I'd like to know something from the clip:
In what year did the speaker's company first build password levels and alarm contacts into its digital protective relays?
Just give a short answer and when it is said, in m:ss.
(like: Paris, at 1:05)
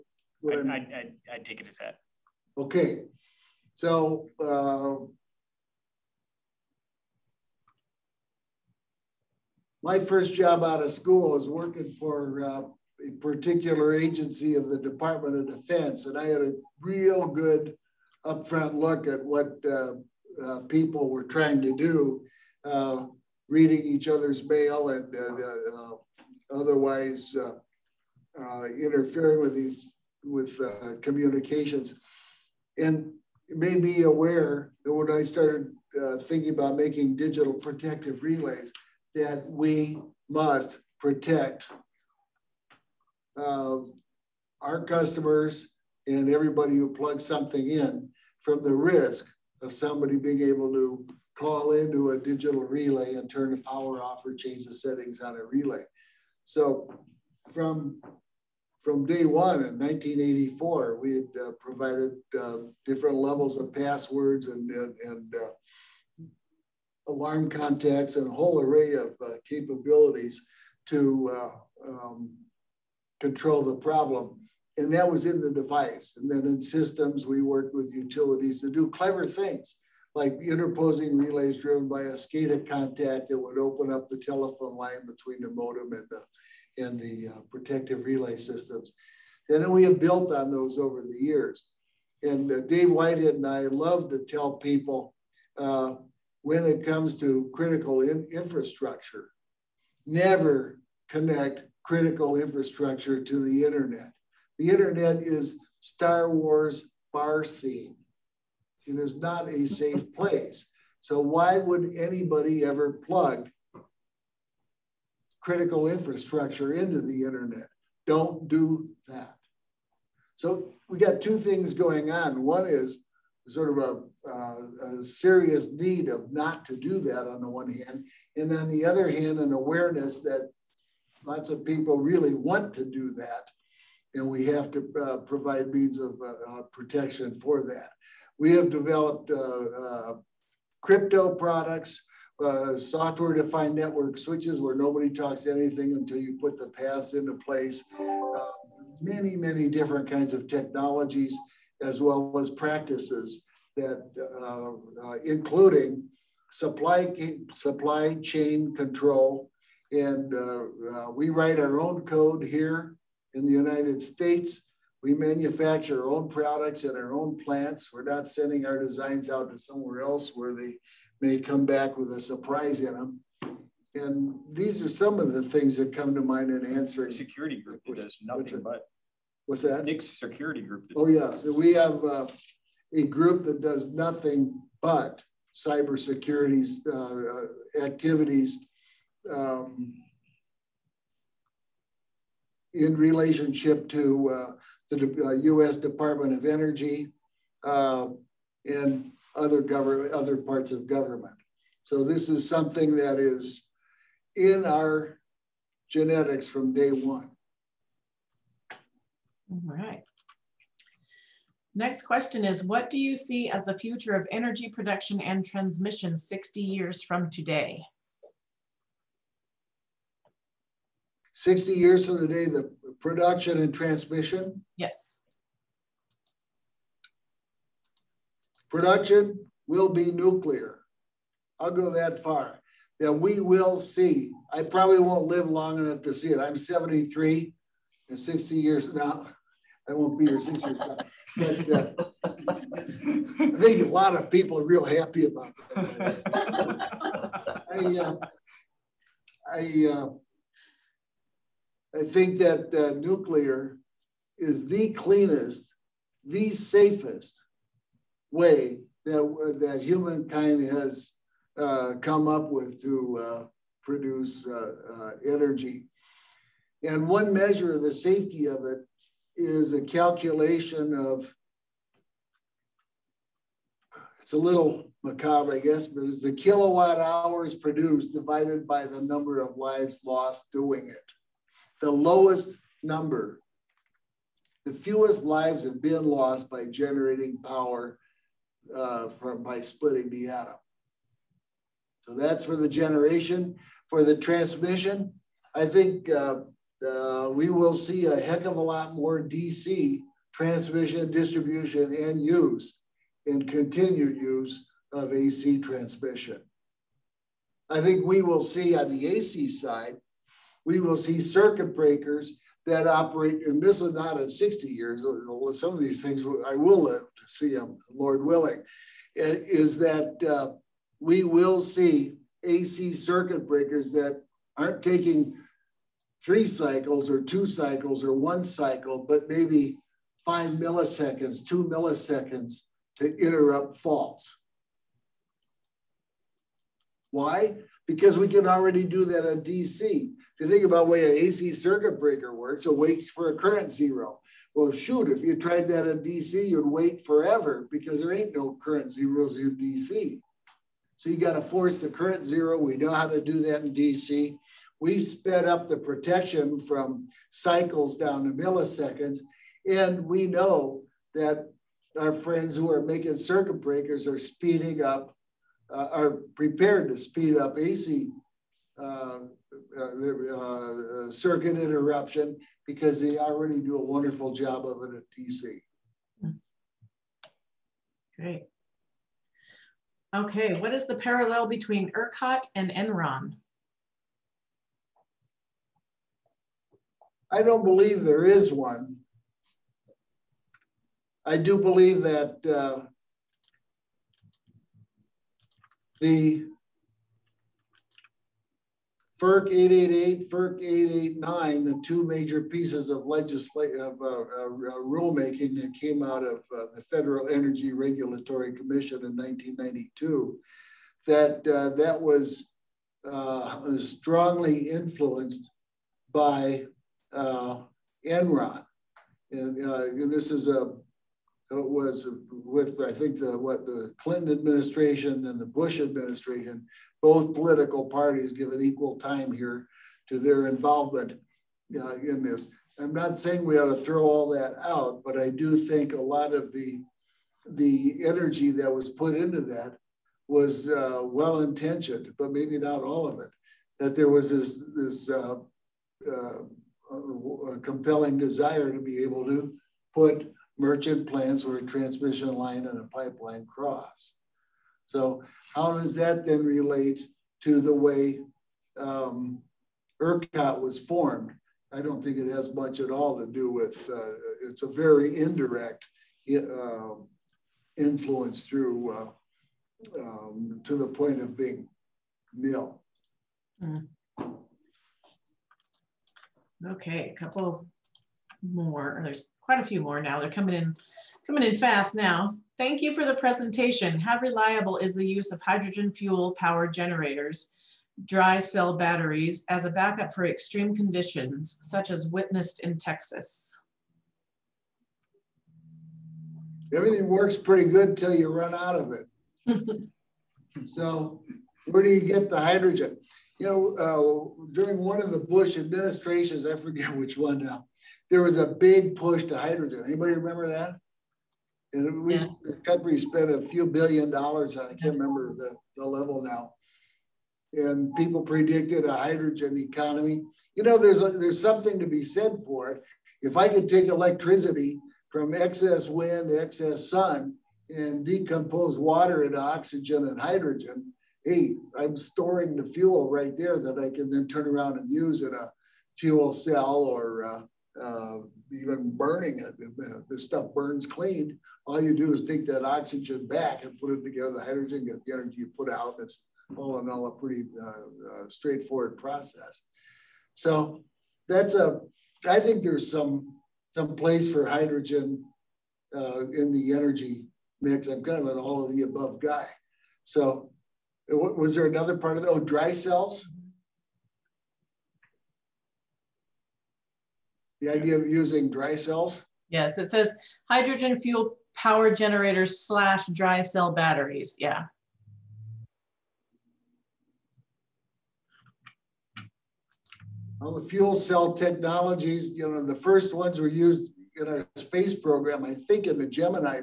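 1984, at 0:59.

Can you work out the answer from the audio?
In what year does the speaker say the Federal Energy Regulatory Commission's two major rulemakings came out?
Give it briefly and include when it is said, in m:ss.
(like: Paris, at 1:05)
1992, at 6:49.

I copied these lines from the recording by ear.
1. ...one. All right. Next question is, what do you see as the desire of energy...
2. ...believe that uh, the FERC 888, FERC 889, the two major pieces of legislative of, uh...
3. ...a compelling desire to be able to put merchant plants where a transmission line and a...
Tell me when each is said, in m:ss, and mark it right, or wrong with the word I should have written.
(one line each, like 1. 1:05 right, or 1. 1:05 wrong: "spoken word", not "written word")
1. 3:26 wrong: "future", not "desire"
2. 6:31 right
3. 7:26 right.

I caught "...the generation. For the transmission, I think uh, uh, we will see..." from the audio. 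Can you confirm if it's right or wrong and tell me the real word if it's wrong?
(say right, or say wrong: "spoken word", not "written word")
right.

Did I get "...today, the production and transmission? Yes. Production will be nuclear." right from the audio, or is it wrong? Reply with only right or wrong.
right.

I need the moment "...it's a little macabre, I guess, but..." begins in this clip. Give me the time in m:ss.
4:34.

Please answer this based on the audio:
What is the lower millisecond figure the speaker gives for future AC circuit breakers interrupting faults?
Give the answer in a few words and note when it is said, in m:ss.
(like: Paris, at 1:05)
2 milliseconds, at 5:31.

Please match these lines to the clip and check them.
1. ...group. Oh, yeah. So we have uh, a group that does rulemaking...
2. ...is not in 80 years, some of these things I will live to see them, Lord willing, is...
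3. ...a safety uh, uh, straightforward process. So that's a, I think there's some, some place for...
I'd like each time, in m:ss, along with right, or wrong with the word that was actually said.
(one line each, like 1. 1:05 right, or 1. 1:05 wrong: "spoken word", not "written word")
1. 3:00 wrong: "nothing", not "rulemaking"
2. 5:13 wrong: "60", not "80"
3. 9:07 wrong: "pretty", not "safety".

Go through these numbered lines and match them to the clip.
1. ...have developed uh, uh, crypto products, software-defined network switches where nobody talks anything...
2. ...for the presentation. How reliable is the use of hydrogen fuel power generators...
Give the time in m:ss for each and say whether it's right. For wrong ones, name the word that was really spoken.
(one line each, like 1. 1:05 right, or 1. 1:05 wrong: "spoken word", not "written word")
1. 2:18 right
2. 8:02 right.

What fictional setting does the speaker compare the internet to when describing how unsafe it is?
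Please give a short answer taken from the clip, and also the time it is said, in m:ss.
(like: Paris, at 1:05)
Star Wars bar scene, at 1:45.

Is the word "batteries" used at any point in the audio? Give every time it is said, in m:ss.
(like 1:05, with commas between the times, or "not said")
8:08, 9:33.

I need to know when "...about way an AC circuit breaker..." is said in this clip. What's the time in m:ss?
5:40.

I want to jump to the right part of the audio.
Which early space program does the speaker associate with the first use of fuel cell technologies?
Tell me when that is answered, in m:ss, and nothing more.
9:46.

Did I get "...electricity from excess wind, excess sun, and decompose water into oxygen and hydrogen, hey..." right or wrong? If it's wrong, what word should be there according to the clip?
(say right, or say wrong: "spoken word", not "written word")
right.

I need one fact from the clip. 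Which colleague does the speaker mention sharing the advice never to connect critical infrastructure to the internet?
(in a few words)
Dave Whitehead.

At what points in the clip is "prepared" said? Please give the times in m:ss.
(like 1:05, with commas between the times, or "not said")
6:06.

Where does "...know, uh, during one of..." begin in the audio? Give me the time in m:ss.
8:23.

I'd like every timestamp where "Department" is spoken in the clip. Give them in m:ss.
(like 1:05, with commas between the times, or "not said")
0:14, 3:15.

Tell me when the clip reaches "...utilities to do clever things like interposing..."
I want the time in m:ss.
1:17.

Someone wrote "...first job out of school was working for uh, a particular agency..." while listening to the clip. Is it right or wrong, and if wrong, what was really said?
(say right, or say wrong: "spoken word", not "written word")
right.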